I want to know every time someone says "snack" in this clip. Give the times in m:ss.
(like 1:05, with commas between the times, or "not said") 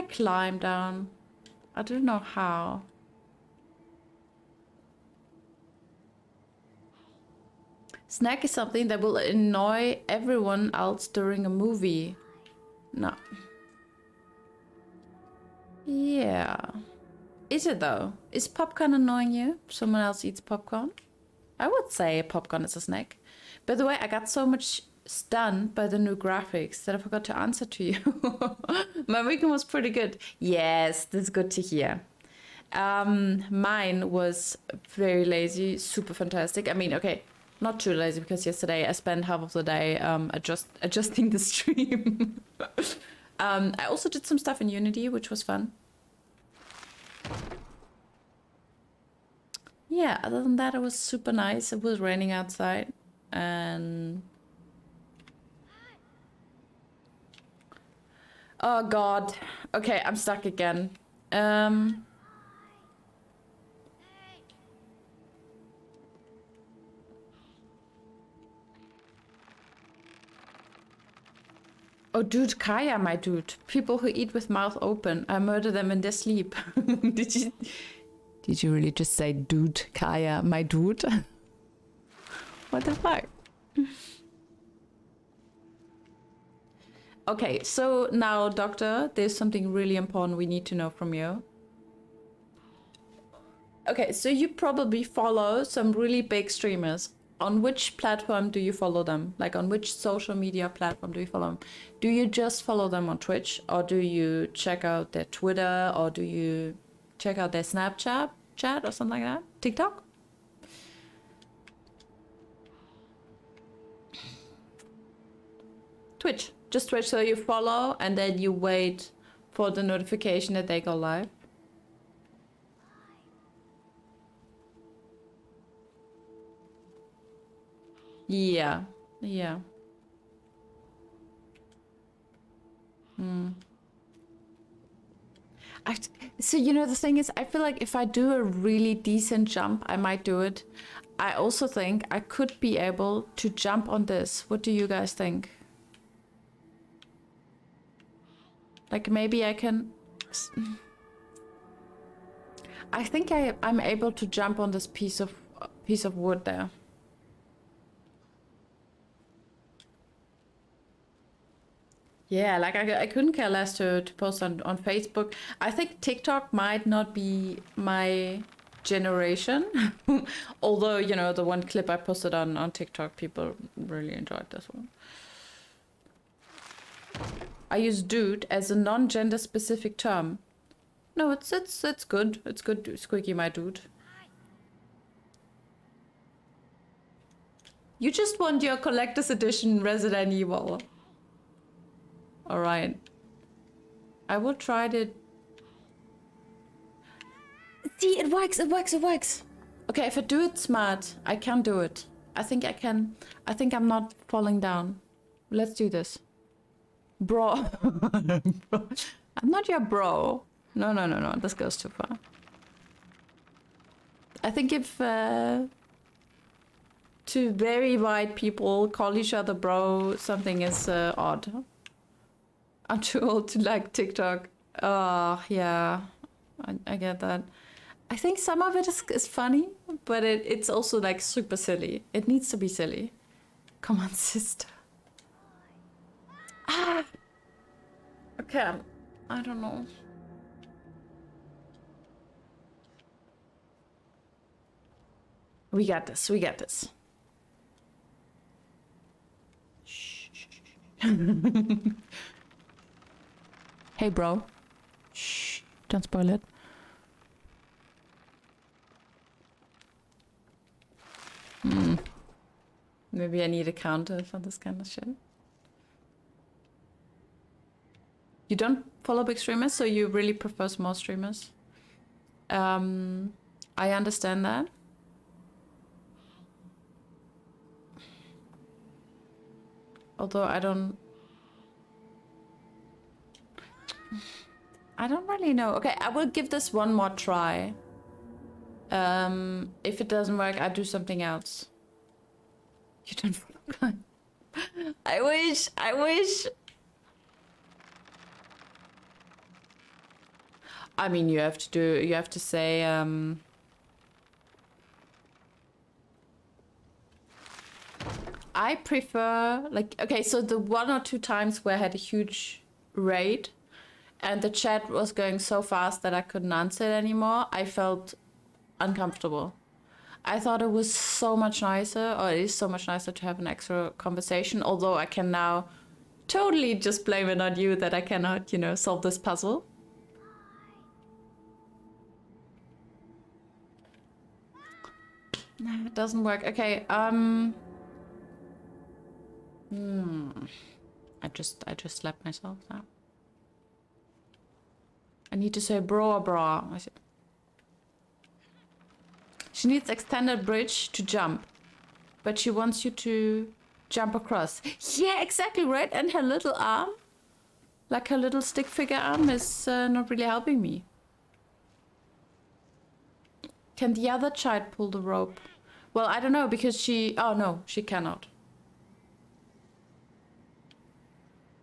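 0:08, 0:22.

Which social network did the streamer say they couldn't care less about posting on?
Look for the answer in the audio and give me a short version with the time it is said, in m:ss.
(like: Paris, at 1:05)
Facebook, at 2:44.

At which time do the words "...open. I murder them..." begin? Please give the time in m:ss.
1:14.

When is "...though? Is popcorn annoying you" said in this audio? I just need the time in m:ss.
0:17.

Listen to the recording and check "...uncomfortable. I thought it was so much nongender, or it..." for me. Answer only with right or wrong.
wrong.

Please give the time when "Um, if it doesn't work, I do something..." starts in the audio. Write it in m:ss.
4:48.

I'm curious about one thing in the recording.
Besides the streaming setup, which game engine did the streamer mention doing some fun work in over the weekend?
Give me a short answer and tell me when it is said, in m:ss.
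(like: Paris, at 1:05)
Unity, at 0:44.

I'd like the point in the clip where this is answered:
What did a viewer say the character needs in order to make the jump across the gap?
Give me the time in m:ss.
5:49.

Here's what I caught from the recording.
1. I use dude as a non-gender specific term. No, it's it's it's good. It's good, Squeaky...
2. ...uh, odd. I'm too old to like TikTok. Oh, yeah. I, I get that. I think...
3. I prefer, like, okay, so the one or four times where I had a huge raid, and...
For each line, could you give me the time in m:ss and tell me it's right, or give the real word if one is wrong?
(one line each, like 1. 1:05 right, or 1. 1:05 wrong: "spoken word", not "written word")
1. 2:57 right
2. 3:40 right
3. 5:08 wrong: "two", not "four".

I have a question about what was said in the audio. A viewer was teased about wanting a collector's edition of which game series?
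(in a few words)
Resident Evil.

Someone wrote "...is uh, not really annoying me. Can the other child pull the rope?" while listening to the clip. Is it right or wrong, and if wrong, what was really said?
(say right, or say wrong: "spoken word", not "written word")
wrong: "helping", not "annoying".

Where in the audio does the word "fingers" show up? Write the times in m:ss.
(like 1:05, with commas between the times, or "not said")
not said.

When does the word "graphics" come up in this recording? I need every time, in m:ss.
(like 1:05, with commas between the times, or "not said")
0:26.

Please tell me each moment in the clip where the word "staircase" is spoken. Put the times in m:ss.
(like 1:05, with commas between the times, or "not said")
not said.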